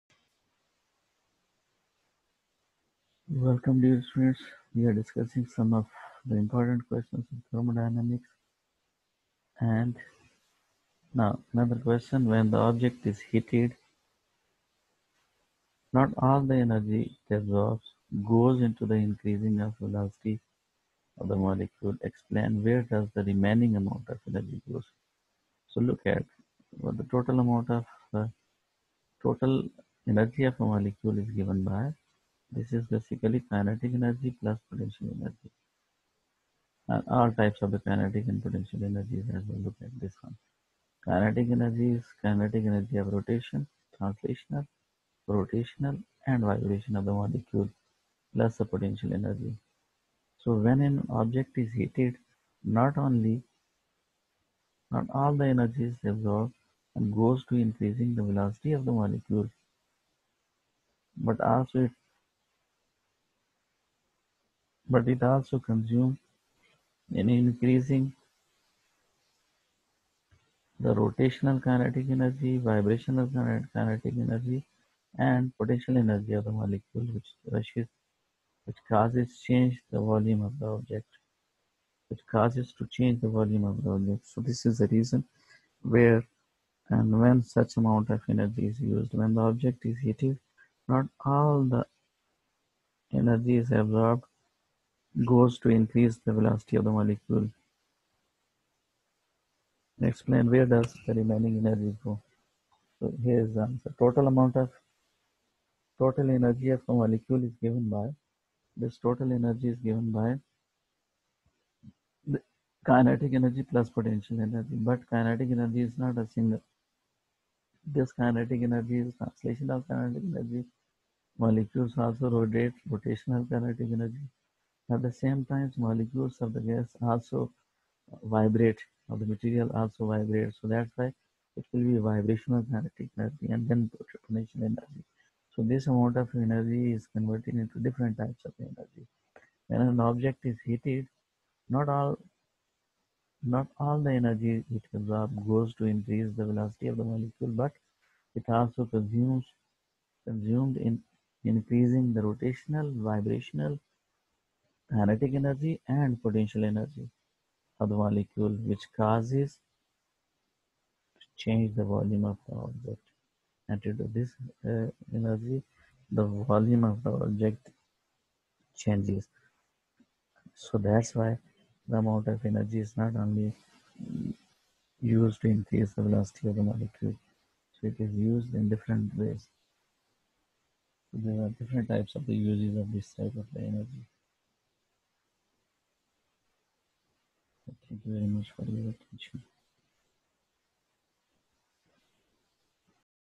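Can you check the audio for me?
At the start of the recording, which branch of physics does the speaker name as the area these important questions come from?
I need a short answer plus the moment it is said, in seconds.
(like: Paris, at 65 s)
Thermodynamics, at 7 s.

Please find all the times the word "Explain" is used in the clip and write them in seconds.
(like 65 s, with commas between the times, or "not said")
22 s, 100 s.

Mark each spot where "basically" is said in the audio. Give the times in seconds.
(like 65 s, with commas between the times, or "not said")
32 s.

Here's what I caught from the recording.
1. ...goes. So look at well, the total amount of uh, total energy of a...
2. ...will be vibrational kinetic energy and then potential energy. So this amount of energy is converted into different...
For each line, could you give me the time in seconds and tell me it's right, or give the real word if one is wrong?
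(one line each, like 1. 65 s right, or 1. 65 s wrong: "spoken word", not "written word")
1. 24 s right
2. 131 s right.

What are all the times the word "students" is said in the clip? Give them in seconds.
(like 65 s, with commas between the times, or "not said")
4 s.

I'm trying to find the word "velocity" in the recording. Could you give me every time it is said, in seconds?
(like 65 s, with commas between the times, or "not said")
19 s, 58 s, 96 s, 146 s, 176 s.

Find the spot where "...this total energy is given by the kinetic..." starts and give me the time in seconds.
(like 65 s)
108 s.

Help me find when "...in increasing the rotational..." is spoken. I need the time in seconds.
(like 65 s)
150 s.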